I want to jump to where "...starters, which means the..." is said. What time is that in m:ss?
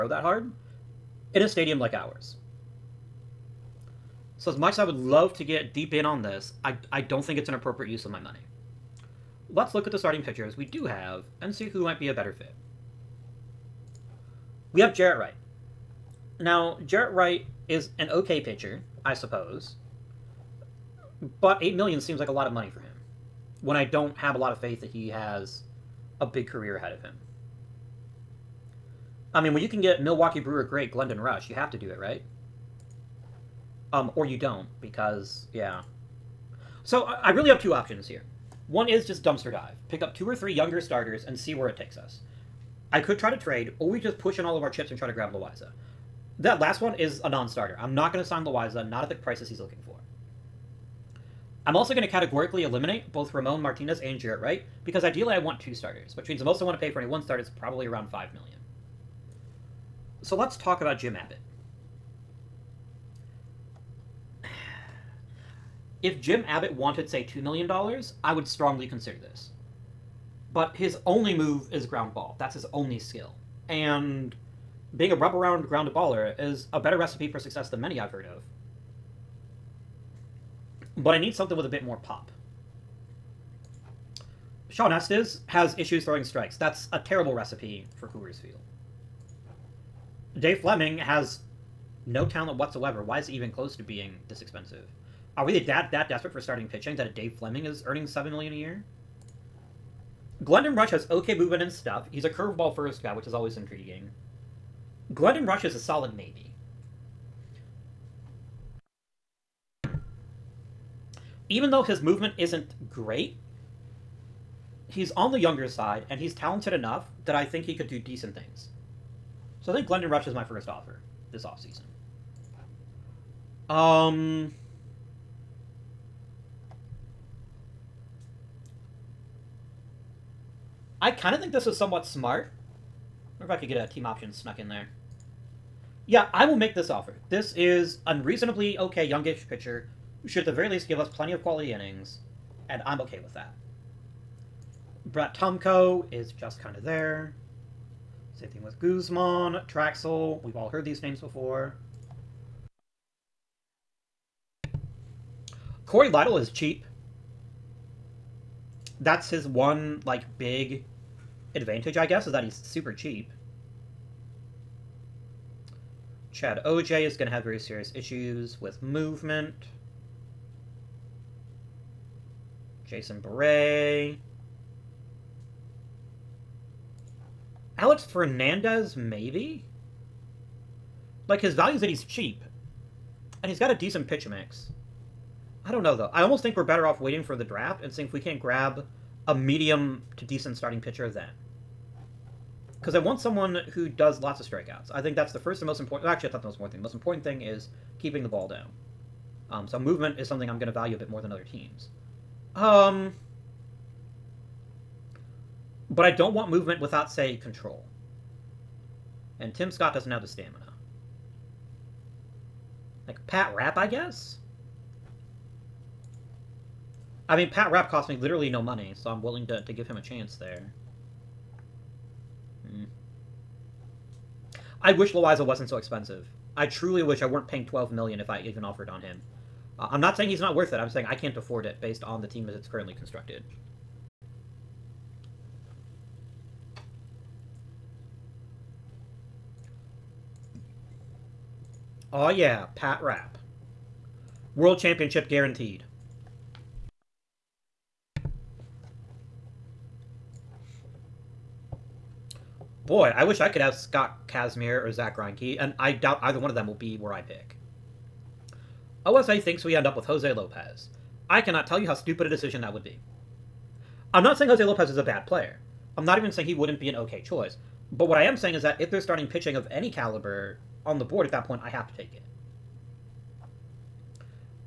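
0:55.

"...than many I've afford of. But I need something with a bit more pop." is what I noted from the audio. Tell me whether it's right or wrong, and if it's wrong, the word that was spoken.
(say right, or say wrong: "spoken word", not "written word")
wrong: "heard", not "afford".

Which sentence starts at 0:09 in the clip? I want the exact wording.
Let's look at the starting pitchers we do have and see who might be a better fit.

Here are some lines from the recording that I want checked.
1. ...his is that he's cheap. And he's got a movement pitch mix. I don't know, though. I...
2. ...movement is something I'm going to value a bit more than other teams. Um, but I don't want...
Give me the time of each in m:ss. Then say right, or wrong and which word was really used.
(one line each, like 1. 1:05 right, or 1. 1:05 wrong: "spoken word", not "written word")
1. 3:01 wrong: "decent", not "movement"
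2. 3:19 right.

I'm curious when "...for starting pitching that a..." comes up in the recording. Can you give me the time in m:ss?
1:36.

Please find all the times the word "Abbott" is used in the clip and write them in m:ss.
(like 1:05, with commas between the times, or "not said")
1:01, 1:06.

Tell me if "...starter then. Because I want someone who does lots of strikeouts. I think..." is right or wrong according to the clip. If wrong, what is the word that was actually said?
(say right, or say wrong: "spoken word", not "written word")
wrong: "pitcher", not "starter".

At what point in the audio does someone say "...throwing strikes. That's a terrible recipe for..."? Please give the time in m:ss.
1:26.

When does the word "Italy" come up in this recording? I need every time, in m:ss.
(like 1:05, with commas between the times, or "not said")
not said.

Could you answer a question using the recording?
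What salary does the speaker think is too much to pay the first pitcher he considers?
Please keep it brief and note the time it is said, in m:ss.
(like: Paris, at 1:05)
8 million, at 0:21.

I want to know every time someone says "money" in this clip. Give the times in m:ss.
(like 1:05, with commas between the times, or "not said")
0:08, 0:22, 3:38.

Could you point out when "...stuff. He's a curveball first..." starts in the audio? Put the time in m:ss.
1:41.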